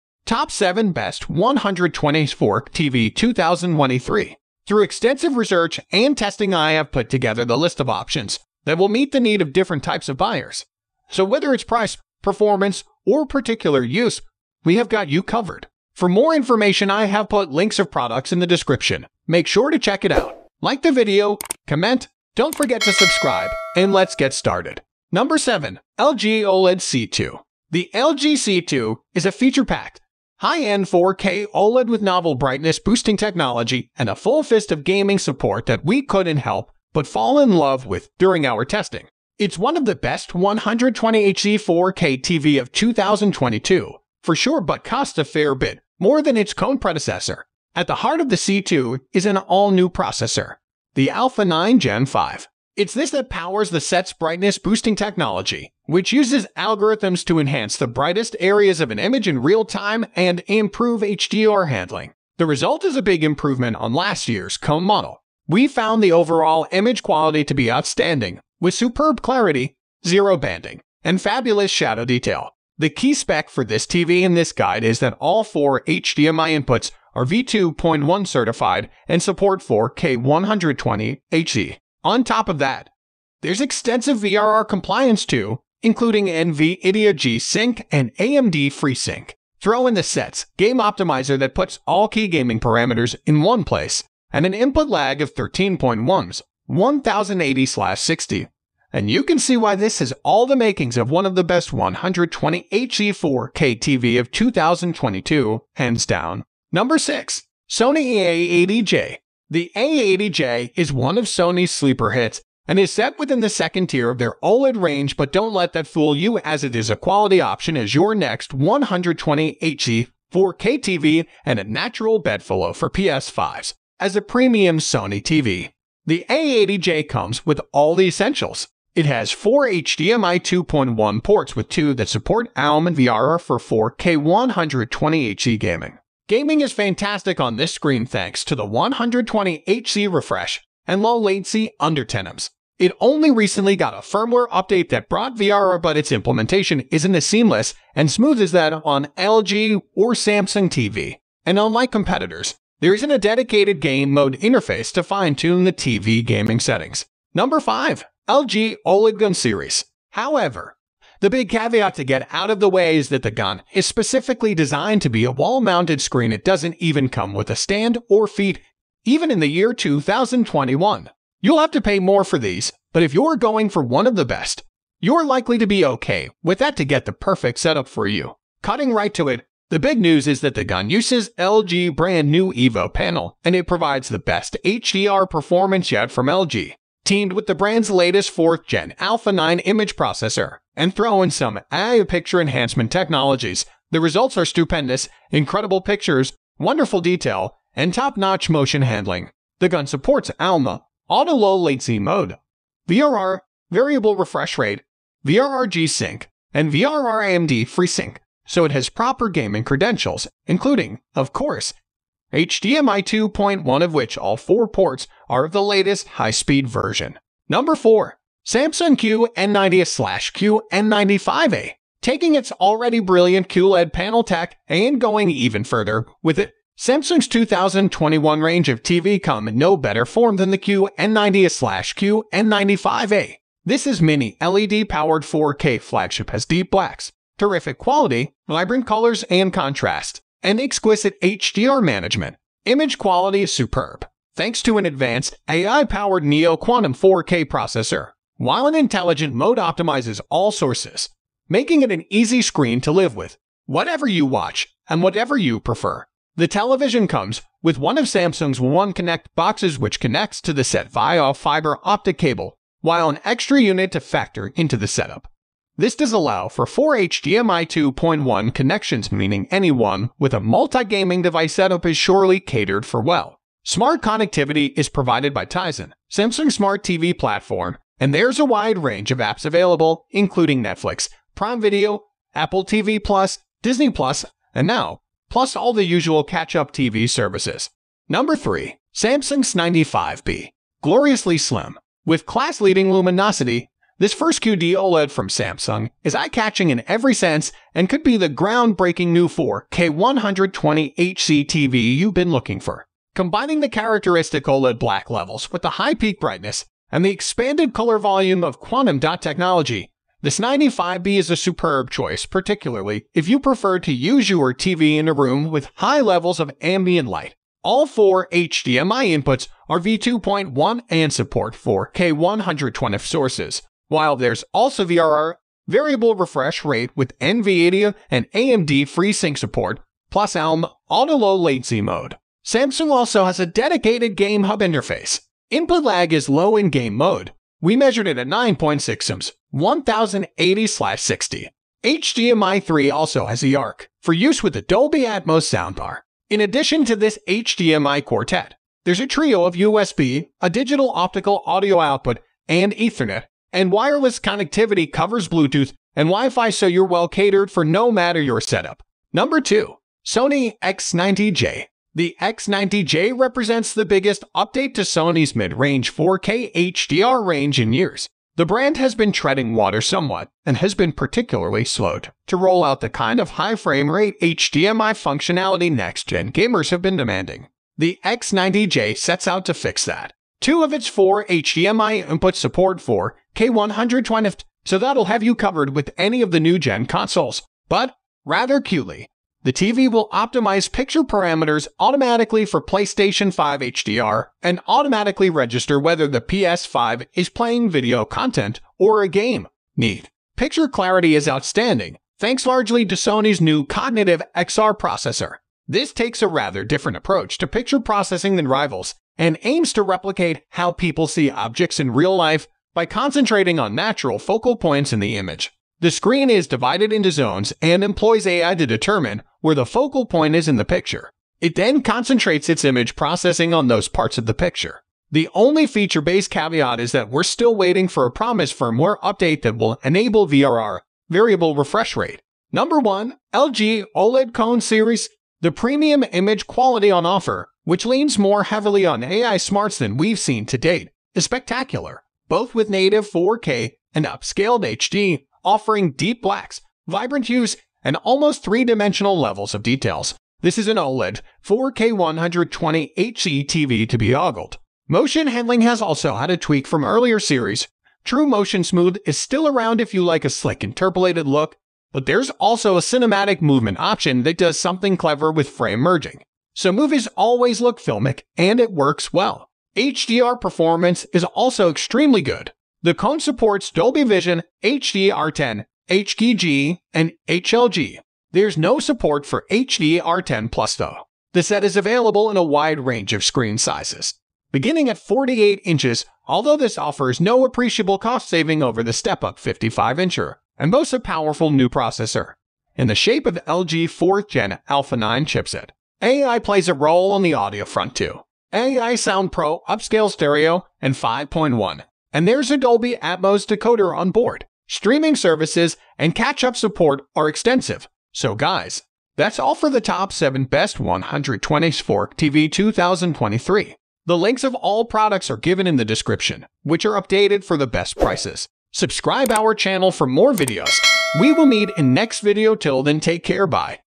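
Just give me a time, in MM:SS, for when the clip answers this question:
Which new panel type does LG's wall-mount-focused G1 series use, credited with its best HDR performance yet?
03:02.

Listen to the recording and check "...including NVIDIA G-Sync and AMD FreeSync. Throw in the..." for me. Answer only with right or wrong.
right.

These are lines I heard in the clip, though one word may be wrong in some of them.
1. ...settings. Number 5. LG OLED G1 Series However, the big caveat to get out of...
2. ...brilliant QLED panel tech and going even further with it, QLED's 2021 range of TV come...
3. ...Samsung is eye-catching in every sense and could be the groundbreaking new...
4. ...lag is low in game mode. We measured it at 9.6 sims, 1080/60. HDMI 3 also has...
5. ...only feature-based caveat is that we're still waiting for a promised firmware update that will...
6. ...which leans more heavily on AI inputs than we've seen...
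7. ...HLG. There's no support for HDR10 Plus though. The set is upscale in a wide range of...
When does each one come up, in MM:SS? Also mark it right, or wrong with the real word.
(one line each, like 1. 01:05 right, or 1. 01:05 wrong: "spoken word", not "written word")
1. 02:36 right
2. 03:42 wrong: "Samsung", not "QLED"
3. 04:55 right
4. 05:35 right
5. 07:05 right
6. 07:17 wrong: "smarts", not "inputs"
7. 07:57 wrong: "available", not "upscale".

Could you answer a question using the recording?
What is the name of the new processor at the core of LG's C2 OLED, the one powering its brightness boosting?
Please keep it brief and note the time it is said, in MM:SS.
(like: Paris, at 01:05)
Alpha 9 Gen 5, at 00:51.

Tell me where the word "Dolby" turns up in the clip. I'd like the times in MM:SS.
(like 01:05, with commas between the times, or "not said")
05:44, 07:53, 08:22.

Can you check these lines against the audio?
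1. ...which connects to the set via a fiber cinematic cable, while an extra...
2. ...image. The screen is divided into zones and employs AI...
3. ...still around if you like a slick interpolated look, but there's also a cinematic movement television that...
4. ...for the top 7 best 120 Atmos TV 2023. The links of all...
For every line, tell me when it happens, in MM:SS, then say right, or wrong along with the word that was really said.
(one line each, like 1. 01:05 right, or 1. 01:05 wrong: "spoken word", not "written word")
1. 04:19 wrong: "optic", not "cinematic"
2. 06:55 right
3. 07:39 wrong: "option", not "television"
4. 08:29 wrong: "Fork", not "Atmos".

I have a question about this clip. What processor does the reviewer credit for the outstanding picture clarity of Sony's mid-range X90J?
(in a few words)
Cognitive XR.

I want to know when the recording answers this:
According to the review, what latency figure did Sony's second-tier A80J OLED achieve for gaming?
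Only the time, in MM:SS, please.
02:21.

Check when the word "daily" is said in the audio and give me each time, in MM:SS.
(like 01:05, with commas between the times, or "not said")
not said.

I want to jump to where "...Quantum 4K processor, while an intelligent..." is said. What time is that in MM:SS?
04:06.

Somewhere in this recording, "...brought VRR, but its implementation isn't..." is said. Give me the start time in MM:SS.
02:25.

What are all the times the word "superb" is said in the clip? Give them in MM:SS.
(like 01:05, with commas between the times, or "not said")
01:08, 04:03, 05:11.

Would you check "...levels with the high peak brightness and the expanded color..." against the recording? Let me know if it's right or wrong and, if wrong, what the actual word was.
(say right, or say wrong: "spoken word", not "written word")
right.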